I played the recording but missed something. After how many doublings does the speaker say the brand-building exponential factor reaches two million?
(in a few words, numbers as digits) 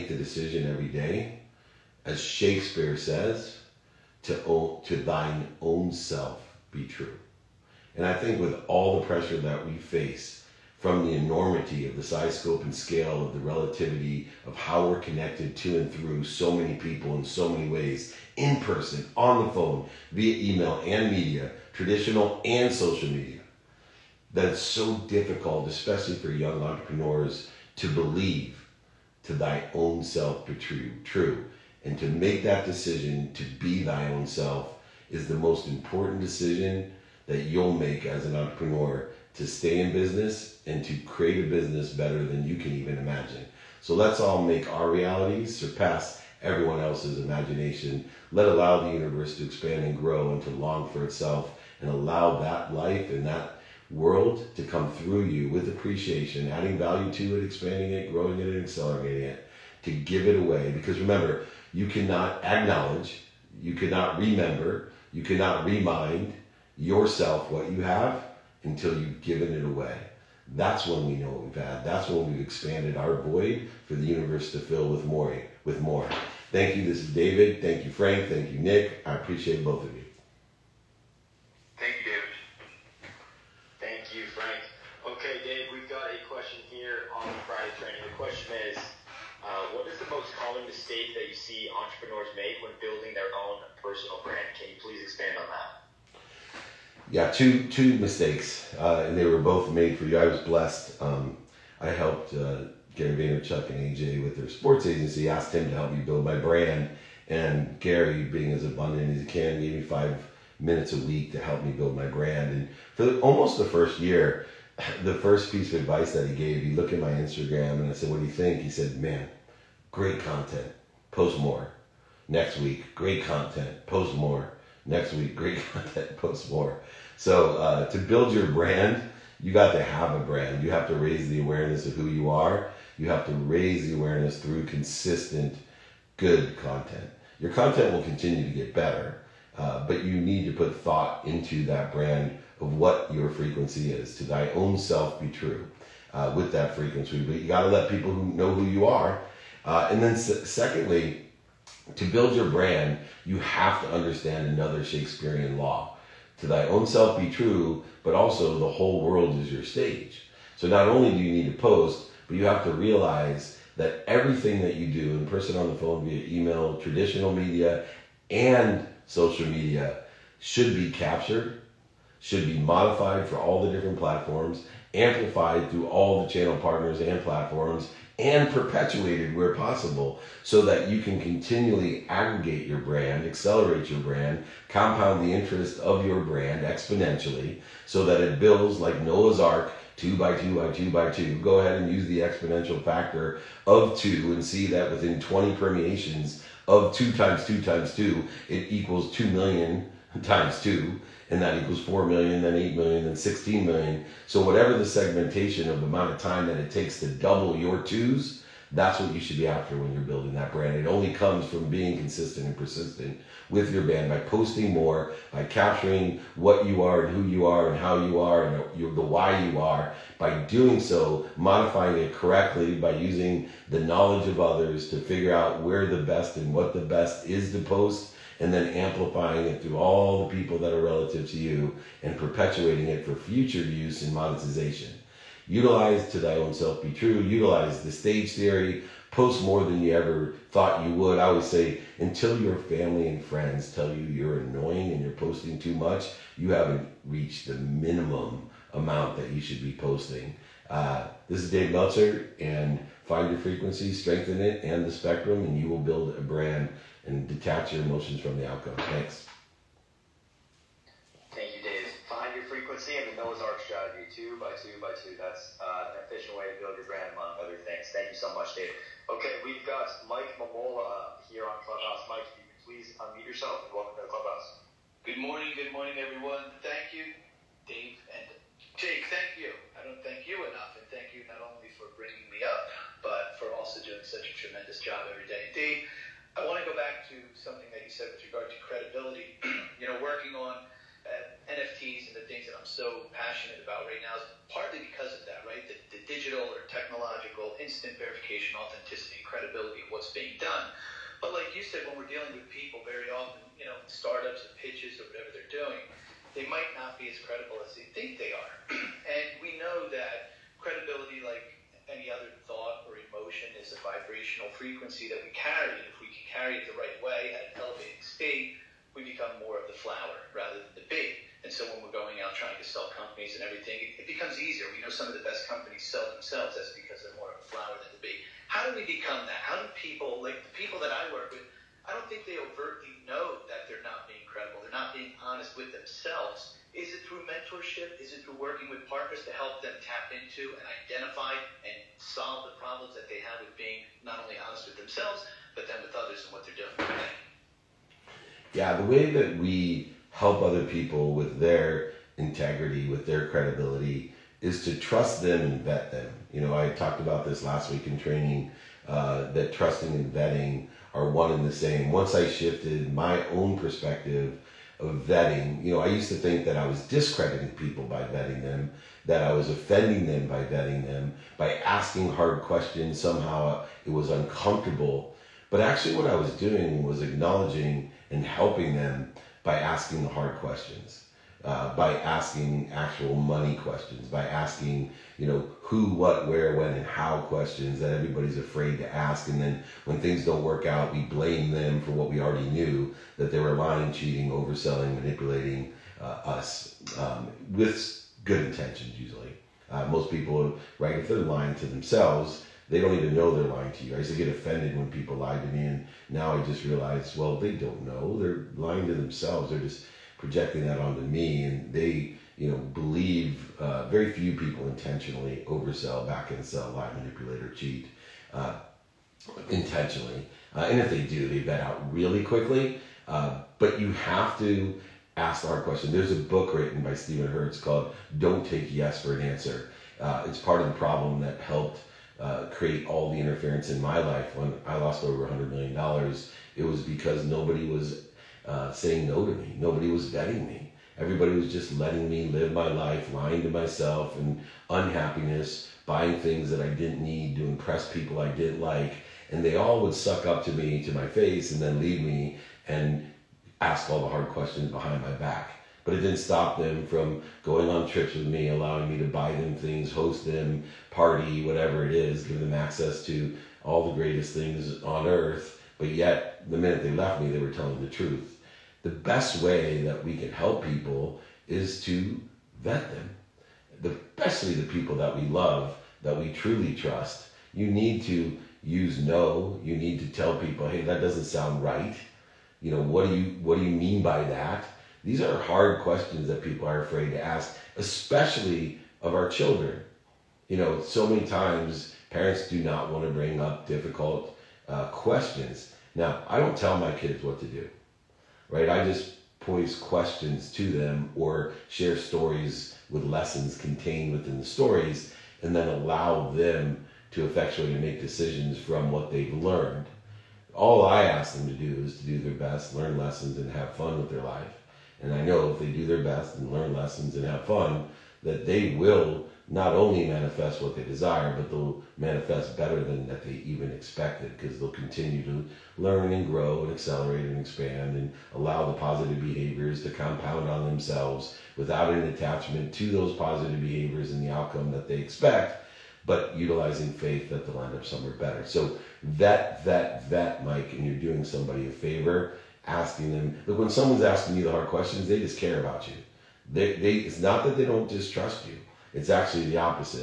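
20.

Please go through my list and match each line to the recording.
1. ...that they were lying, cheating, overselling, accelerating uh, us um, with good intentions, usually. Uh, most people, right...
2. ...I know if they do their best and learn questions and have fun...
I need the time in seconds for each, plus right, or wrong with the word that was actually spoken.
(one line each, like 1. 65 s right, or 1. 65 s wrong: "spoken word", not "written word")
1. 393 s wrong: "manipulating", not "accelerating"
2. 515 s wrong: "lessons", not "questions".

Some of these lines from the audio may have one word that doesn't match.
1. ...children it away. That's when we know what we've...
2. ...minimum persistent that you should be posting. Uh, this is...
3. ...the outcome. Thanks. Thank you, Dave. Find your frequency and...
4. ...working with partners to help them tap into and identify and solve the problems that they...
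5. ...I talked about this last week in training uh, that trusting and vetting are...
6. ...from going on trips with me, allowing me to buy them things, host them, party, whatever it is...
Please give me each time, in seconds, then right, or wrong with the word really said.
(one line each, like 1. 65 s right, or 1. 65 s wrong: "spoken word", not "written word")
1. 69 s wrong: "given", not "children"
2. 247 s wrong: "amount", not "persistent"
3. 258 s right
4. 338 s right
5. 356 s right
6. 456 s right.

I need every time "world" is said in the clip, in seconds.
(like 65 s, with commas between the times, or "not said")
53 s, 159 s.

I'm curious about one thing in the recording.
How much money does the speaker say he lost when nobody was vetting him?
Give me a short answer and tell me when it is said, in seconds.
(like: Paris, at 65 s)
over $100 million, at 435 s.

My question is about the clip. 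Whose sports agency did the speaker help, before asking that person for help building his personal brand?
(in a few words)
Gary Vaynerchuk.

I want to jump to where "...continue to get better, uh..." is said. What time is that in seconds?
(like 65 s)
138 s.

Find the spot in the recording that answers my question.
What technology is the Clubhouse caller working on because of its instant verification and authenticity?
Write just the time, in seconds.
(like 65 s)
291 s.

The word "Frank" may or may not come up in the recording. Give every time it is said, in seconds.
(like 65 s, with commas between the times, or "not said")
77 s, 84 s.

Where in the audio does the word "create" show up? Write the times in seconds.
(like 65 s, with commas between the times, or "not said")
40 s, 432 s.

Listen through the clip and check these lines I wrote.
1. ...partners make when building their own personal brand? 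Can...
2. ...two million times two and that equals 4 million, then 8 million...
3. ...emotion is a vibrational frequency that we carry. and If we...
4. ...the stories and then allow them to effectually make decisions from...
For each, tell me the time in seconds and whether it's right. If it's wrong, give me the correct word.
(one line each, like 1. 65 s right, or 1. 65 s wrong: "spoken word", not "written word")
1. 91 s wrong: "entrepreneurs", not "partners"
2. 199 s right
3. 312 s right
4. 504 s right.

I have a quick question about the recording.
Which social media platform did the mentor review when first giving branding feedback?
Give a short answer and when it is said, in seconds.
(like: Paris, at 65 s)
Instagram, at 117 s.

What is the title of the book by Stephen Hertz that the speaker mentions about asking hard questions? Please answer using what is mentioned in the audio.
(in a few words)
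Don't Take Yes for an Answer.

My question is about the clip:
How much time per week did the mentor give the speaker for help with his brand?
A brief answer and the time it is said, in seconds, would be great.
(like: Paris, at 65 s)
5 minutes, at 109 s.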